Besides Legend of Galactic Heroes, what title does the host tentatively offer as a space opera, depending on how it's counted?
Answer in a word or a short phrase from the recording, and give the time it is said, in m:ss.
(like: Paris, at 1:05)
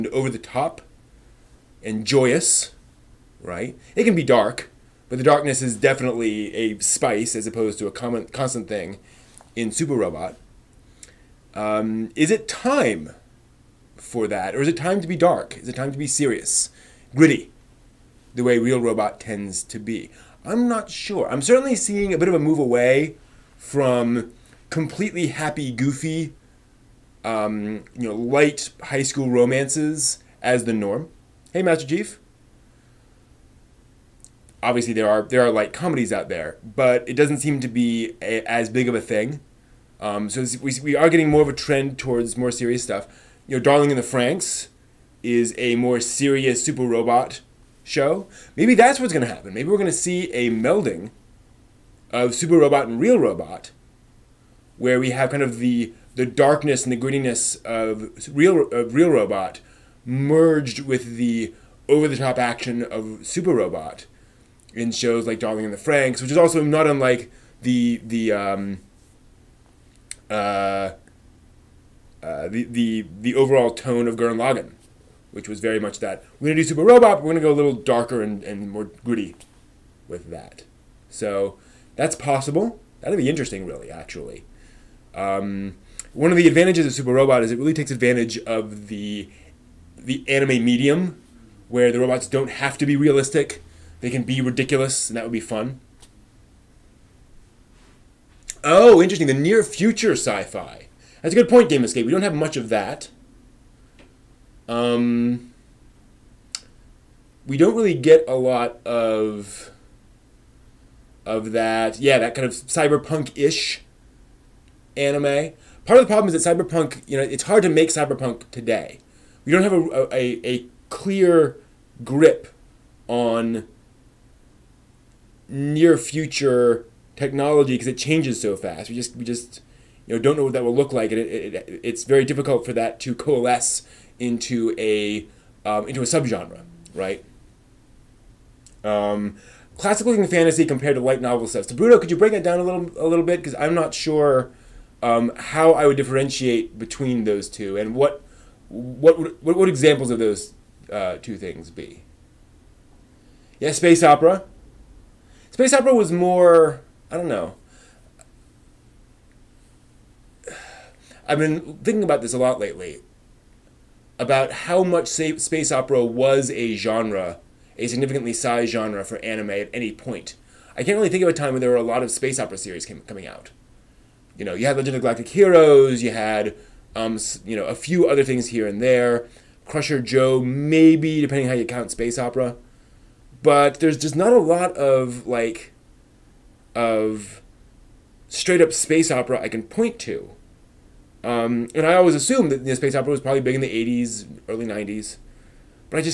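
Crusher Joe, at 2:59.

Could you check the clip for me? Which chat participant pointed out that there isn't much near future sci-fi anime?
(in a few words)
Game Escape.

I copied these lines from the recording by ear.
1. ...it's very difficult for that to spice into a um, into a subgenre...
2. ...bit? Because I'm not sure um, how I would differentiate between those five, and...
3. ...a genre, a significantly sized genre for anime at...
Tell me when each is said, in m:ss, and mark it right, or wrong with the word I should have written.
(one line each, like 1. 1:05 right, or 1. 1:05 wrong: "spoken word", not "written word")
1. 2:11 wrong: "coalesce", not "spice"
2. 2:23 wrong: "two", not "five"
3. 2:46 right.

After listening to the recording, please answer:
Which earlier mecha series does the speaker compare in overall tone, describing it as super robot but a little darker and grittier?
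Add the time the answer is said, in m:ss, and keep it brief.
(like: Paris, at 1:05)
Gurren Lagann, at 1:14.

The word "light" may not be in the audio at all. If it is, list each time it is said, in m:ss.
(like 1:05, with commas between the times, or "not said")
0:28, 0:35, 2:21.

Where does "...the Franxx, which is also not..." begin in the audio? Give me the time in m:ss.
1:05.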